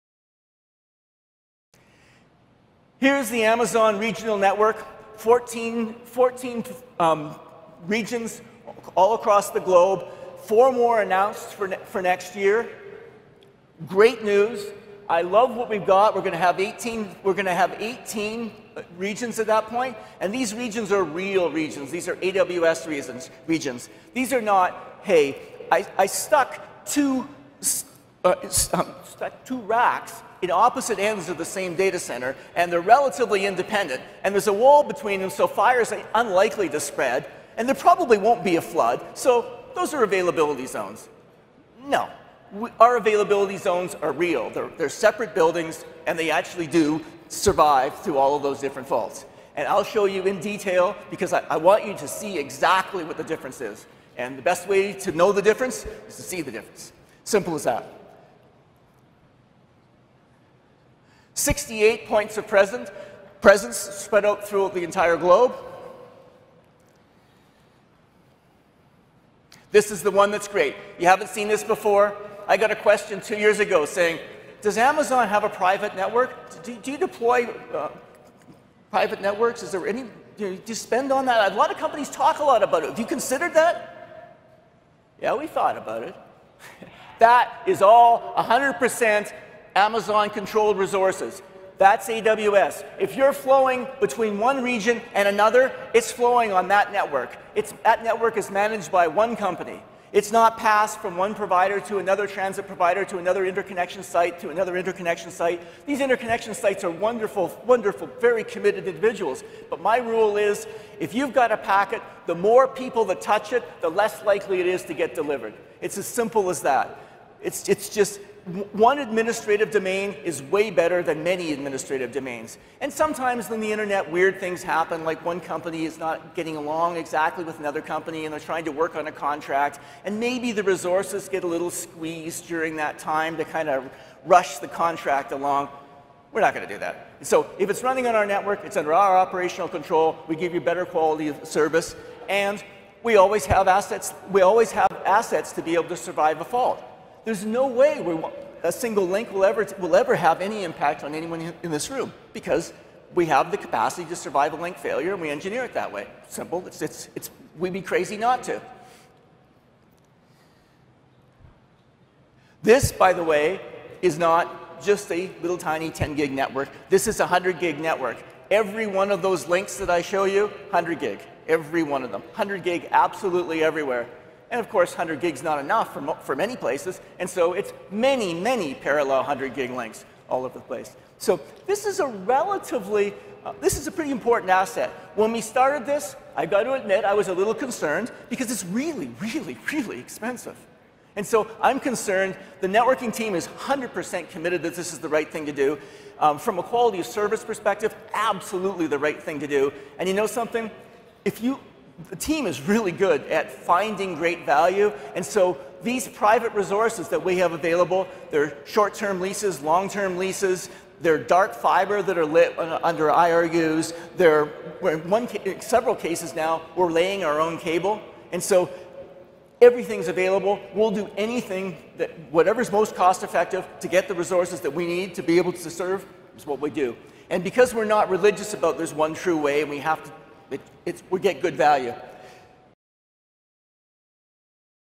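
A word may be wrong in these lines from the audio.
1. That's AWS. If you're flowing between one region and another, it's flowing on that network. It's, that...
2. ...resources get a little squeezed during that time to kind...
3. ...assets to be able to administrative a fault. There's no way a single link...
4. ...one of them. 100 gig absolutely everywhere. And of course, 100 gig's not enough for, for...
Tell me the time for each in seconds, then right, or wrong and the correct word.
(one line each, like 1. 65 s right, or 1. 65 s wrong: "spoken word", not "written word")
1. 91 s right
2. 130 s right
3. 145 s wrong: "survive", not "administrative"
4. 171 s right.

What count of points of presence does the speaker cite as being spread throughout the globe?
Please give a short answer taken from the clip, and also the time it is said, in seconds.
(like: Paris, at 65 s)
68, at 61 s.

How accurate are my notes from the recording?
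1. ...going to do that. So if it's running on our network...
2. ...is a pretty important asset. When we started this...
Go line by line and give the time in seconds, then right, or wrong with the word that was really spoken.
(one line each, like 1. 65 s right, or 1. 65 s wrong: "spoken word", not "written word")
1. 136 s right
2. 183 s right.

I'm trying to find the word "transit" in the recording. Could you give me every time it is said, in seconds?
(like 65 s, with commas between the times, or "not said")
102 s.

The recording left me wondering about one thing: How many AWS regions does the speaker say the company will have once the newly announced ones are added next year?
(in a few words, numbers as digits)
18.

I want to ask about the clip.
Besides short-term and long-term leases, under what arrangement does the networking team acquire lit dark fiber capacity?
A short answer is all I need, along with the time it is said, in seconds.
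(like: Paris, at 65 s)
IRUs, at 213 s.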